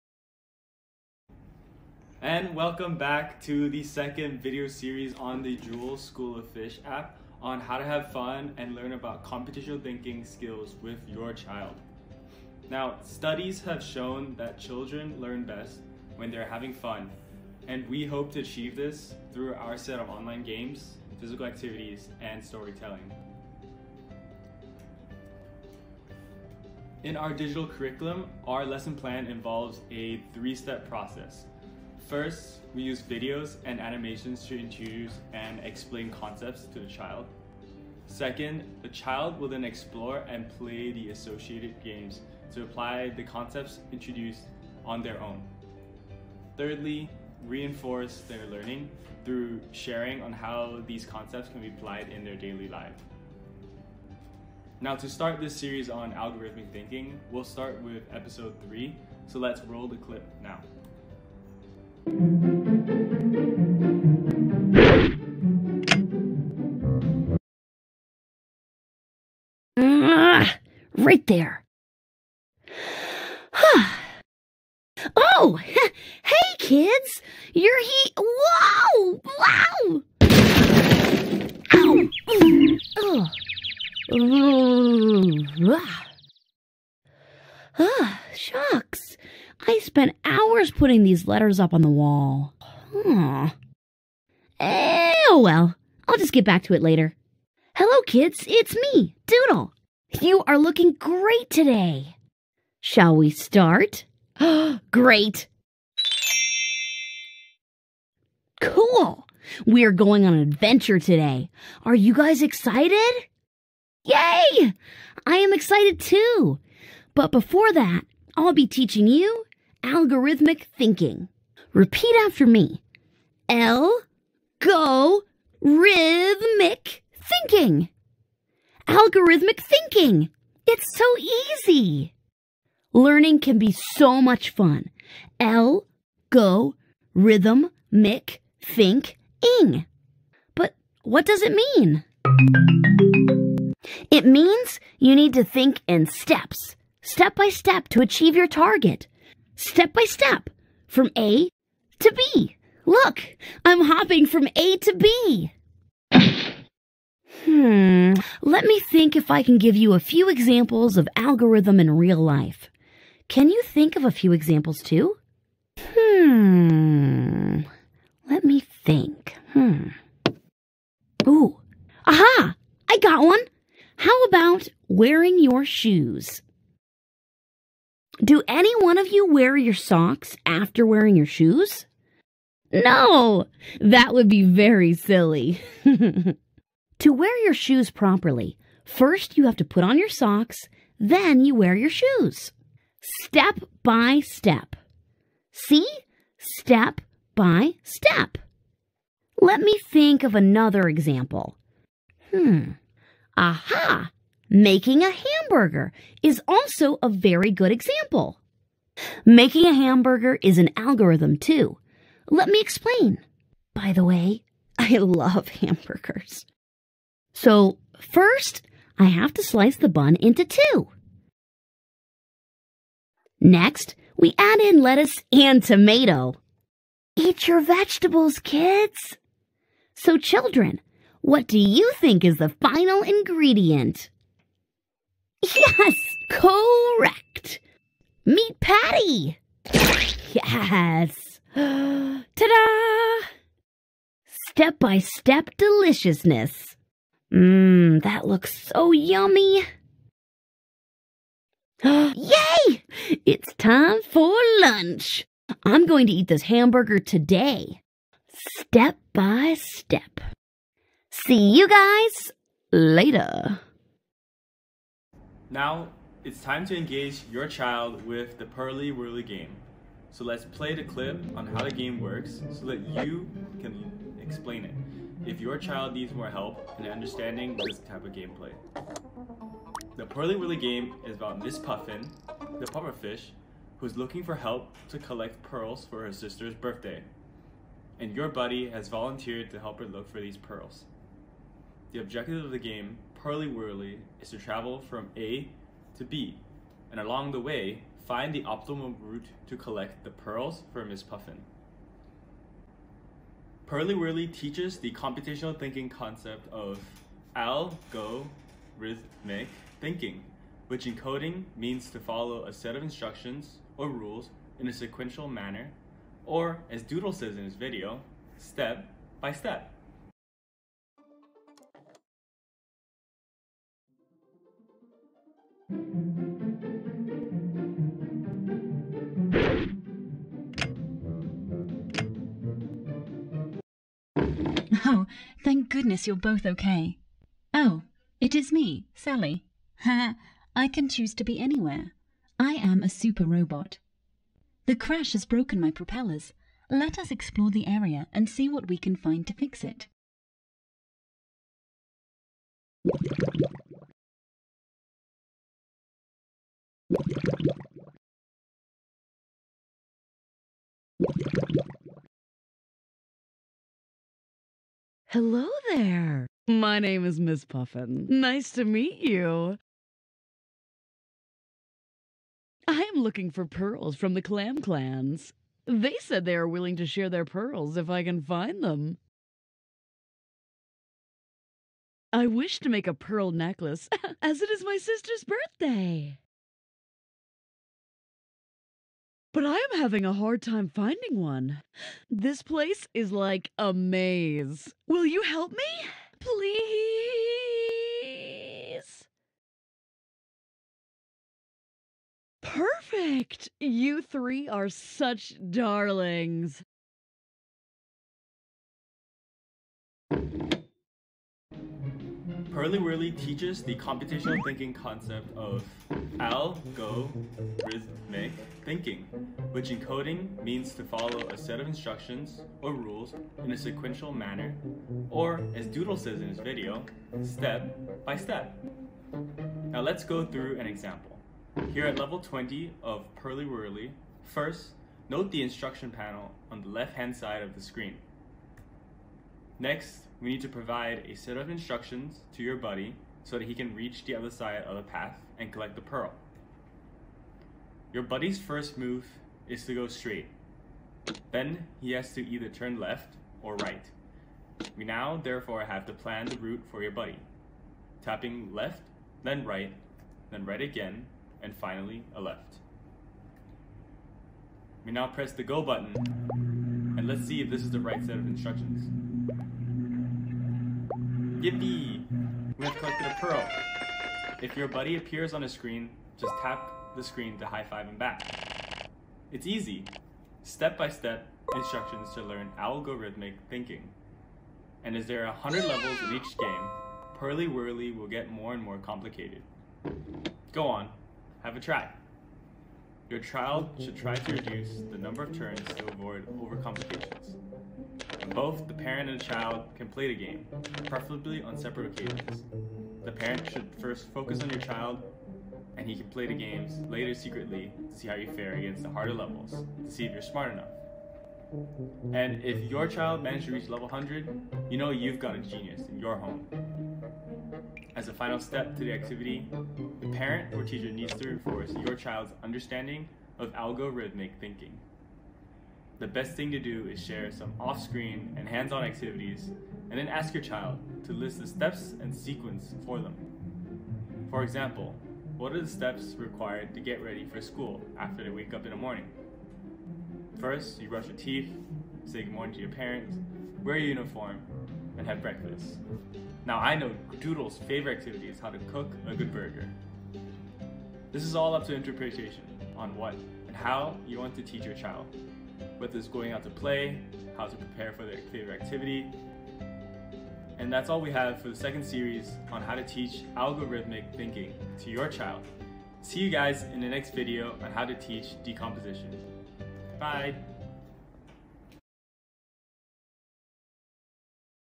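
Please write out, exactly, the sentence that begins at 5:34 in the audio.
Oh, thank goodness you're both okay.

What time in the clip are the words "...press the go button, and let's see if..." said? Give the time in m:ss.
7:45.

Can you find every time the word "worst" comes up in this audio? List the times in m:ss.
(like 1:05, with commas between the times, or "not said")
not said.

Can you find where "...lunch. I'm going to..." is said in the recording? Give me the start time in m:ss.
4:14.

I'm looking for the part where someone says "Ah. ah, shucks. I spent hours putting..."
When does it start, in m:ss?
1:25.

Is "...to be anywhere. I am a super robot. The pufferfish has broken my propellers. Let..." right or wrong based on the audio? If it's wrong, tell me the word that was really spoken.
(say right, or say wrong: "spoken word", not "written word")
wrong: "crash", not "pufferfish".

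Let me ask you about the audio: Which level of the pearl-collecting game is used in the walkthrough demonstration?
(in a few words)
Level 20.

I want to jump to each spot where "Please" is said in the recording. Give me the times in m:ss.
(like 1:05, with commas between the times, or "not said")
6:36.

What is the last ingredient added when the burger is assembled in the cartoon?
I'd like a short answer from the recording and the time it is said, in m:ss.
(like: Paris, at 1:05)
Meat patty, at 3:58.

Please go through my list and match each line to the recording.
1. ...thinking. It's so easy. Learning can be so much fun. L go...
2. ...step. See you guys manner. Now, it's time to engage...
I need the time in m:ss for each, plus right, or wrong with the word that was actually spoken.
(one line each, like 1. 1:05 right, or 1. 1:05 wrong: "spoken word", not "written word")
1. 2:09 right
2. 4:19 wrong: "later", not "manner".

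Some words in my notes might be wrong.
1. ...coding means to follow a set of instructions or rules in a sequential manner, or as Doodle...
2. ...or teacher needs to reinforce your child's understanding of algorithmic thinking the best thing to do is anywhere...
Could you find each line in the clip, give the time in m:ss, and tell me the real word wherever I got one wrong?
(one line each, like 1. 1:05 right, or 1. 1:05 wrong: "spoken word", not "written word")
1. 5:10 right
2. 8:40 wrong: "share", not "anywhere".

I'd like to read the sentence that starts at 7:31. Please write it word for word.
Then he has to either turn left or right.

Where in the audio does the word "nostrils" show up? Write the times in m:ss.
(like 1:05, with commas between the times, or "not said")
not said.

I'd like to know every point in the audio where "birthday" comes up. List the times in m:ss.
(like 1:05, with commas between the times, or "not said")
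4:46, 6:25.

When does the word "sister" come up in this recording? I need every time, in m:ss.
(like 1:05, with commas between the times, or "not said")
4:46, 6:24.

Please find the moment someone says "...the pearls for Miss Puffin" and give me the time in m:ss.
5:00.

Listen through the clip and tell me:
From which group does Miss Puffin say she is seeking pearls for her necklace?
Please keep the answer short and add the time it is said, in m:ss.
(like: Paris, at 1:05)
The Clam Clans, at 6:14.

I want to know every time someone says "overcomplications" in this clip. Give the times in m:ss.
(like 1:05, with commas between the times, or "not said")
8:16.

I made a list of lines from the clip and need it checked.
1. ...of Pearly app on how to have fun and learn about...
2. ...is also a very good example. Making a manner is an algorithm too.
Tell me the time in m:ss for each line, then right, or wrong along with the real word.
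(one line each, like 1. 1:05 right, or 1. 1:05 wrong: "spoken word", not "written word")
1. 0:06 wrong: "Fish", not "Pearly"
2. 3:26 wrong: "hamburger", not "manner".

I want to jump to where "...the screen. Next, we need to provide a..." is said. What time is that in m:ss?
7:17.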